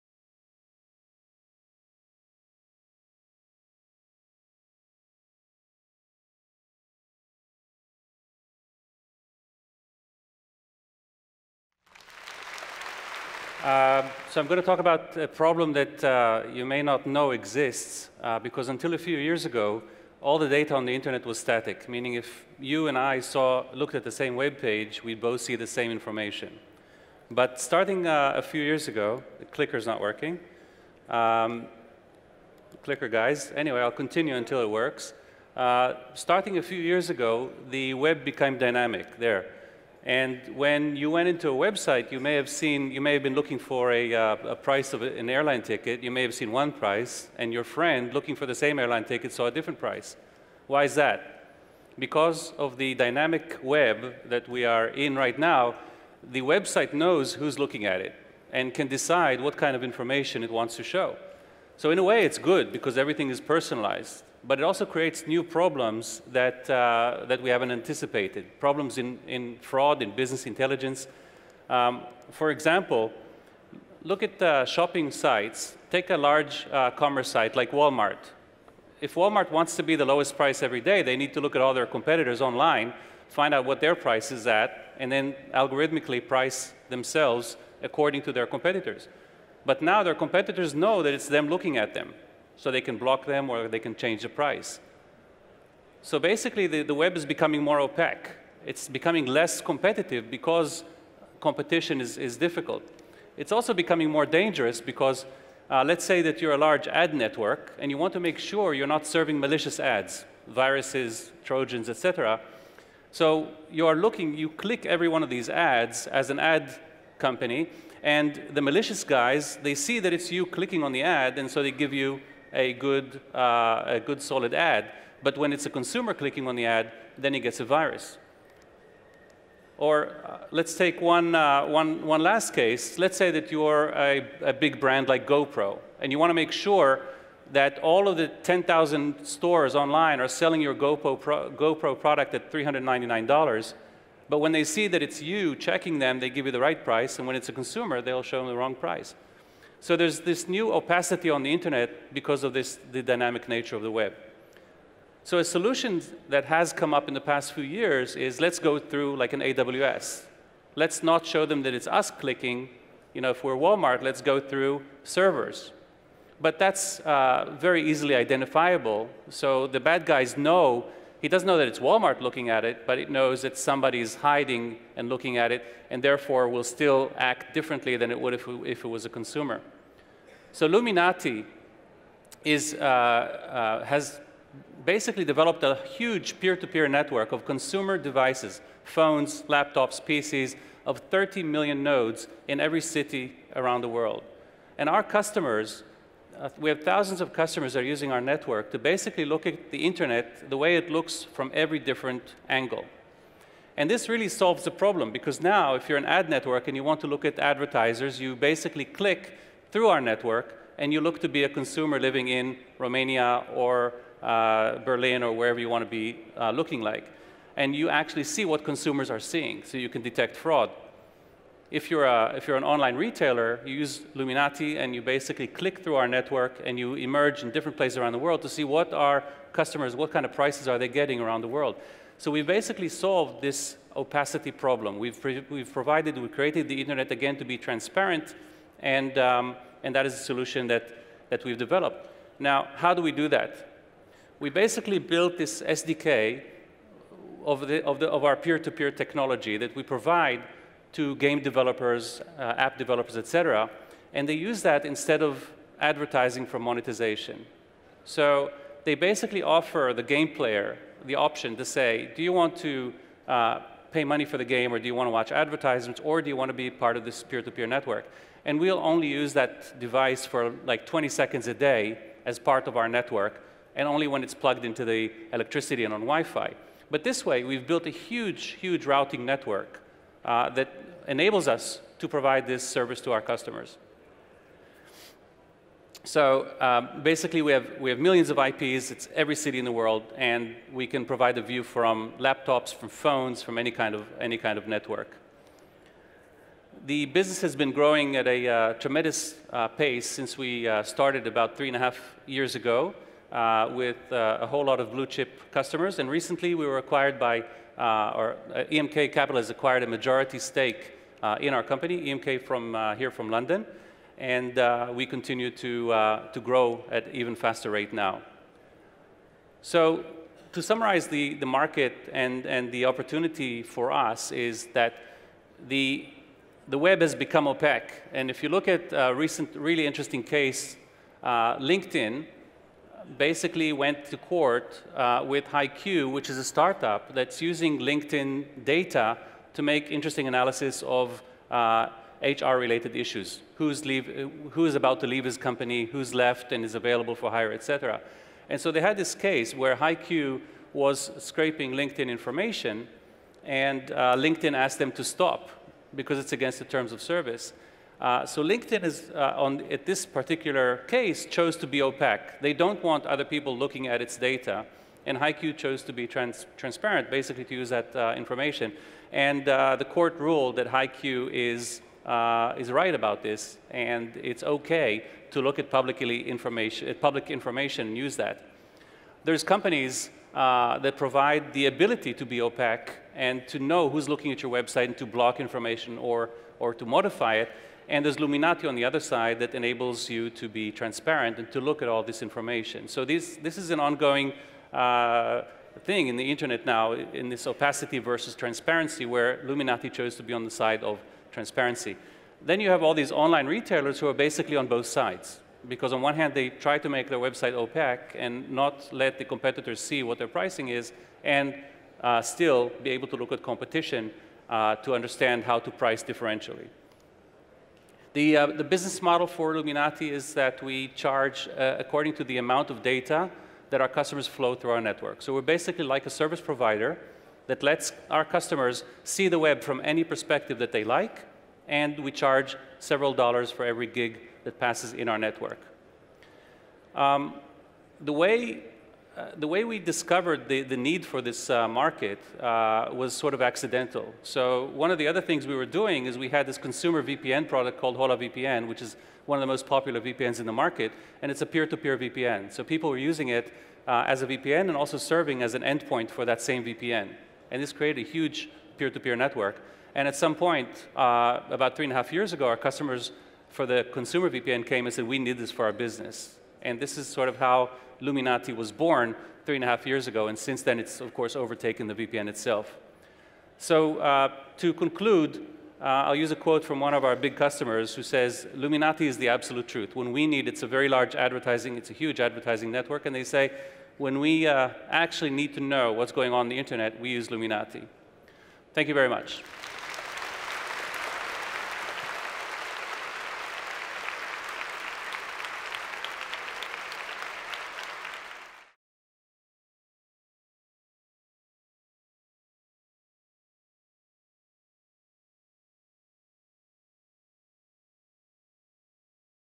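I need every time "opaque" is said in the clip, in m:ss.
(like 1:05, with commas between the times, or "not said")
1:37, 5:27, 6:01, 6:22, 6:47.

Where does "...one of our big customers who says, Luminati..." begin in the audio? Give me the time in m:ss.
7:56.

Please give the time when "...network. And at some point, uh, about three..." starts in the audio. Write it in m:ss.
7:39.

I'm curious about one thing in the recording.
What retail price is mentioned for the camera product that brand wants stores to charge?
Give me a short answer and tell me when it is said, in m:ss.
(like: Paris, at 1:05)
$399, at 2:22.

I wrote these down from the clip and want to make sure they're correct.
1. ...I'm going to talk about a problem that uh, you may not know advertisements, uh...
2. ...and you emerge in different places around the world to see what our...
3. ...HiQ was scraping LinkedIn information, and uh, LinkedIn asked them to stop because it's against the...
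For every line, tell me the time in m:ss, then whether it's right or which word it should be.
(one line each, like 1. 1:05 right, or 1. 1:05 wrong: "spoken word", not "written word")
1. 0:14 wrong: "exists", not "advertisements"
2. 3:46 right
3. 5:49 right.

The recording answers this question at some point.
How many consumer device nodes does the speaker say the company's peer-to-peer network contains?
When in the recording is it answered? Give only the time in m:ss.
3:11.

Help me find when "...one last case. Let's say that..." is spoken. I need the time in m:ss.
2:12.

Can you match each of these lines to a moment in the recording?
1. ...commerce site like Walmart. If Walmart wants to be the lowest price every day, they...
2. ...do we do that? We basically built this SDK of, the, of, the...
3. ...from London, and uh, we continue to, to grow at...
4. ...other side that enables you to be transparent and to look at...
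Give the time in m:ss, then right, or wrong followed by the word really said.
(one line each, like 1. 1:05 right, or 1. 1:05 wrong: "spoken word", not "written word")
1. 1:16 right
2. 4:02 right
3. 5:13 right
4. 6:28 right.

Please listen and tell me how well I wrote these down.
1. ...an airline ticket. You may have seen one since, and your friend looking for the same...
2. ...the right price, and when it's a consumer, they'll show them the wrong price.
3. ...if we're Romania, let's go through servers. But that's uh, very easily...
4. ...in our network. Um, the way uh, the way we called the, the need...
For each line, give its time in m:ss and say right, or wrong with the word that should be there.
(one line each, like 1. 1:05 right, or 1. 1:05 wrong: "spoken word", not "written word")
1. 0:45 wrong: "price", not "since"
2. 2:26 right
3. 2:43 wrong: "Walmart", not "Romania"
4. 7:14 wrong: "discovered", not "called".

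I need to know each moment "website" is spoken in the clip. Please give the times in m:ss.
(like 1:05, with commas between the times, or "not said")
0:41, 0:56, 6:24, 6:47.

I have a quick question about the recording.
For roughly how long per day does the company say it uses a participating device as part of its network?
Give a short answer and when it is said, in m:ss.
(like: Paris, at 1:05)
20 seconds, at 4:30.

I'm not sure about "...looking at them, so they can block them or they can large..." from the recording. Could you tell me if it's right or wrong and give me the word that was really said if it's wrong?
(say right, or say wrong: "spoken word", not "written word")
wrong: "change", not "large".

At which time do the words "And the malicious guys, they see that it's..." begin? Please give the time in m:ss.
1:58.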